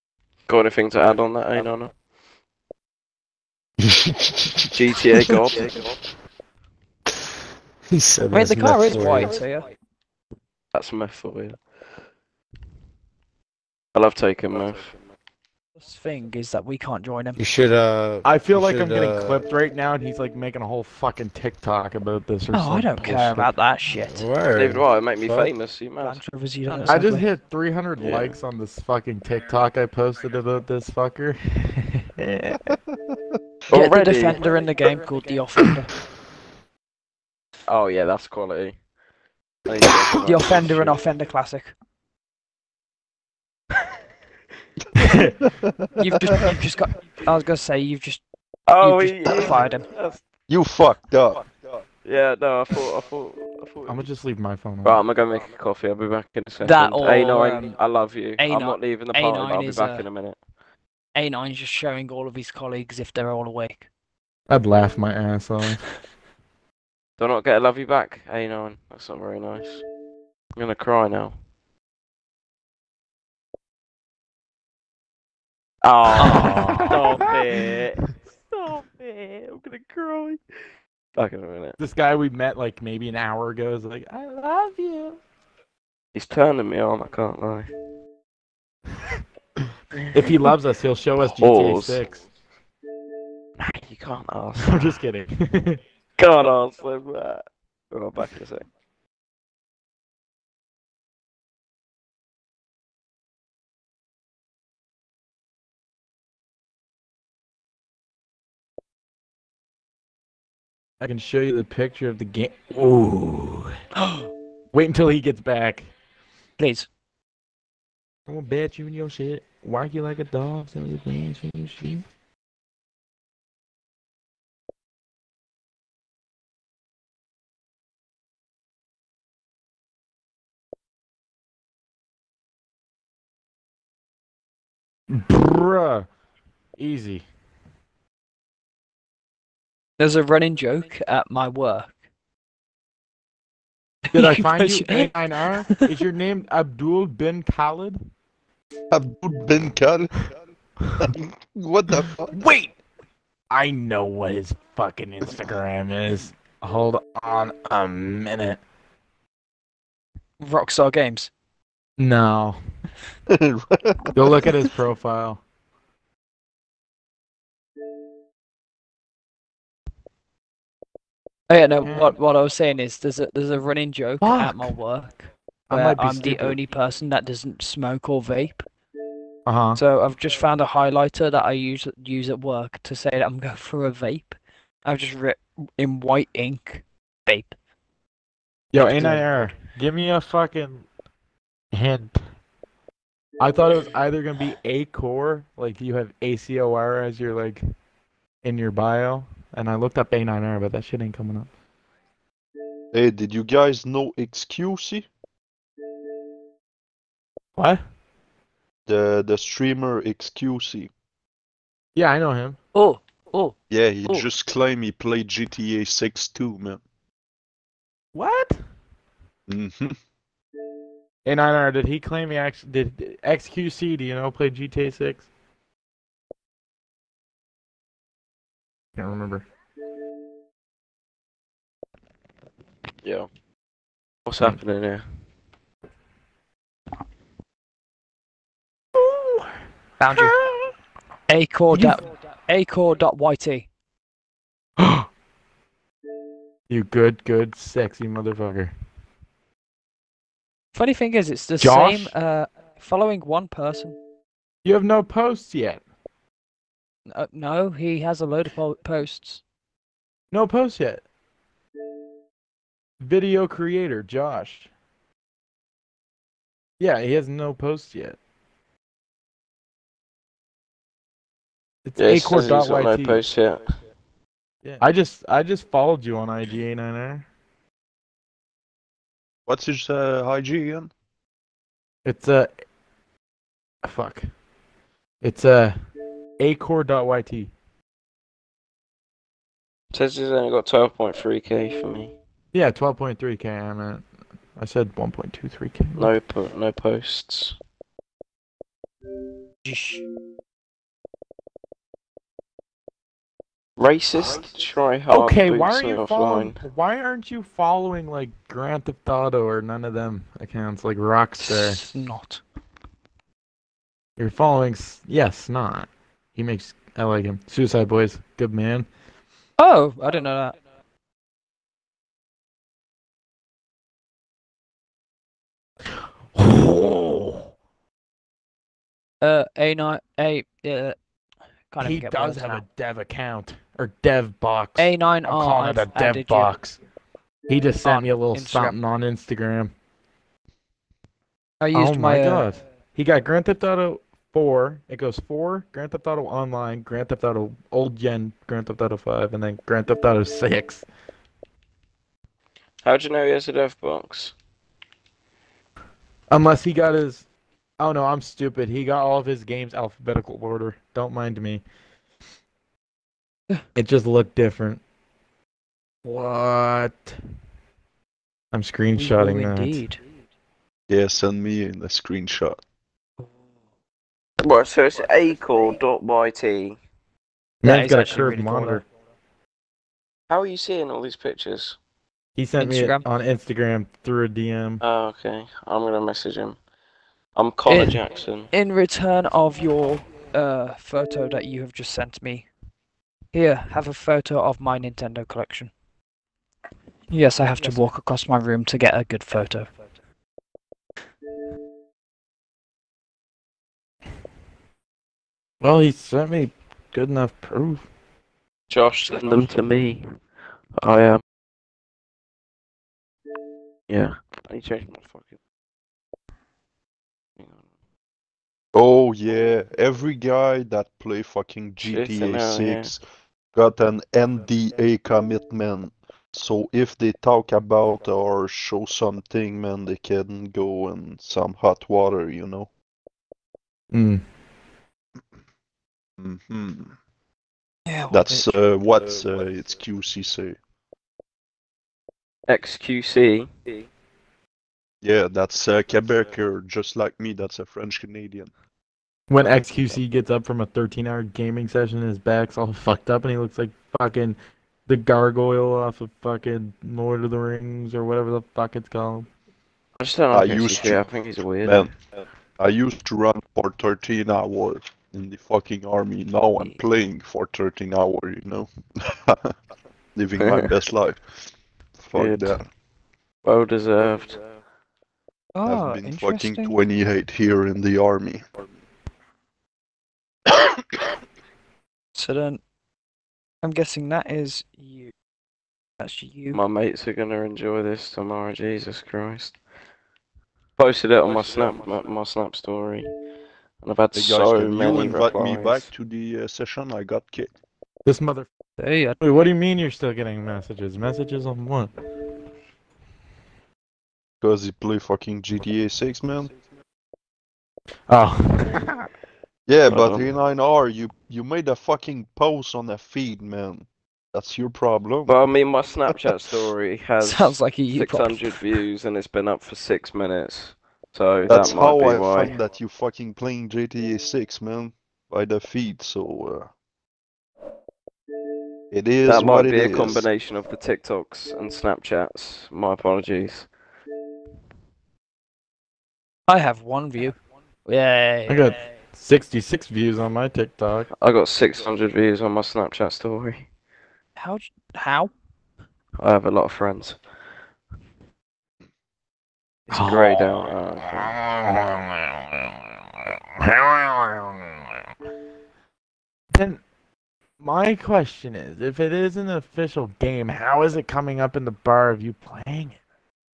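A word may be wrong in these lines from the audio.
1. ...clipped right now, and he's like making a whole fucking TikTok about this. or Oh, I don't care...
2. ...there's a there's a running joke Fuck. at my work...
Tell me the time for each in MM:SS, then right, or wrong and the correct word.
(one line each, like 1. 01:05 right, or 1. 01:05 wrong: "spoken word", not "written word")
1. 00:19 right
2. 02:52 right.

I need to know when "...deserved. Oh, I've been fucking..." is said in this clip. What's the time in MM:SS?
07:53.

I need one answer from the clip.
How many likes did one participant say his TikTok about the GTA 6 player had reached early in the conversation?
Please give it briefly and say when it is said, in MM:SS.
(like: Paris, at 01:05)
300, at 00:27.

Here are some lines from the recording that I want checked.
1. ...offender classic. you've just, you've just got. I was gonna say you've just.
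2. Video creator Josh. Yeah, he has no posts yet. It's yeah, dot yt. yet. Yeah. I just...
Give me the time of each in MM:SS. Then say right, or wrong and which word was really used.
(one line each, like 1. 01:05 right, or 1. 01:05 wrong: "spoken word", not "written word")
1. 00:40 right
2. 04:23 right.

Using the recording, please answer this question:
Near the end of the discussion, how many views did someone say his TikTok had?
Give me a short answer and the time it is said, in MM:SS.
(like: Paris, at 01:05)
66, at 08:59.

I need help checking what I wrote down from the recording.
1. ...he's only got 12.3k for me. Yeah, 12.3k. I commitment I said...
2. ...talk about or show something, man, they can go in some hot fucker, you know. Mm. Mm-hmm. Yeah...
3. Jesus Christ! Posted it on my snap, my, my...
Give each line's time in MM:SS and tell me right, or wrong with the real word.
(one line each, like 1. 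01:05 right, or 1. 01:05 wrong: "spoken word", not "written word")
1. 04:50 wrong: "meant", not "commitment"
2. 07:07 wrong: "water", not "fucker"
3. 08:08 right.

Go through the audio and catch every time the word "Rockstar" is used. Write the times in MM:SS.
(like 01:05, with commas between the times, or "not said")
02:40, 05:10.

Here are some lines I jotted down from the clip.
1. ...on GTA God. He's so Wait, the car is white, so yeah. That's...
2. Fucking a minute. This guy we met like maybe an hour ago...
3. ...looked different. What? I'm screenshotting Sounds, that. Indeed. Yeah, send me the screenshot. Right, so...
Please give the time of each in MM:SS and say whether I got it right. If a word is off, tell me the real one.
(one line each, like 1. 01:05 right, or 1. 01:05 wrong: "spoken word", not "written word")
1. 00:01 right
2. 01:21 right
3. 06:04 wrong: "Ooh", not "Sounds".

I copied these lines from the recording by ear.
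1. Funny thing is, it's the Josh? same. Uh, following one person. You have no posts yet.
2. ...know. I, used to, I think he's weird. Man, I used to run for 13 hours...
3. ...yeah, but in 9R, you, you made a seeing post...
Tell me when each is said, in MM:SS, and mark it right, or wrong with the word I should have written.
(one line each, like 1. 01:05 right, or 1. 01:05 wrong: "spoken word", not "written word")
1. 04:10 right
2. 07:40 right
3. 08:29 wrong: "fucking", not "seeing".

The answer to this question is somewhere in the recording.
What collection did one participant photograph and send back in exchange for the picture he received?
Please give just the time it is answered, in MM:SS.
06:34.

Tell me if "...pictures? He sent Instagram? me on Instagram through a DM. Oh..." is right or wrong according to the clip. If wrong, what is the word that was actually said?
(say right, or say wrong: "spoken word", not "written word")
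right.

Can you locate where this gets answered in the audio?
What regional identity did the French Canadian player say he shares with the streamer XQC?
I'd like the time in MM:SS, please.
07:25.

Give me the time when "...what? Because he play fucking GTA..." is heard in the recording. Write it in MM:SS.
08:21.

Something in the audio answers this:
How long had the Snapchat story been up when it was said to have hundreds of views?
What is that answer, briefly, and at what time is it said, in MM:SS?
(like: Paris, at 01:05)
6 minutes, at 08:39.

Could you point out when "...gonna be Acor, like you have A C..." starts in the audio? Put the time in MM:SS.
03:14.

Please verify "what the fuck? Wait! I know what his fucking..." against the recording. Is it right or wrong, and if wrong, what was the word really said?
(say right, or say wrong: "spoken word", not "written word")
right.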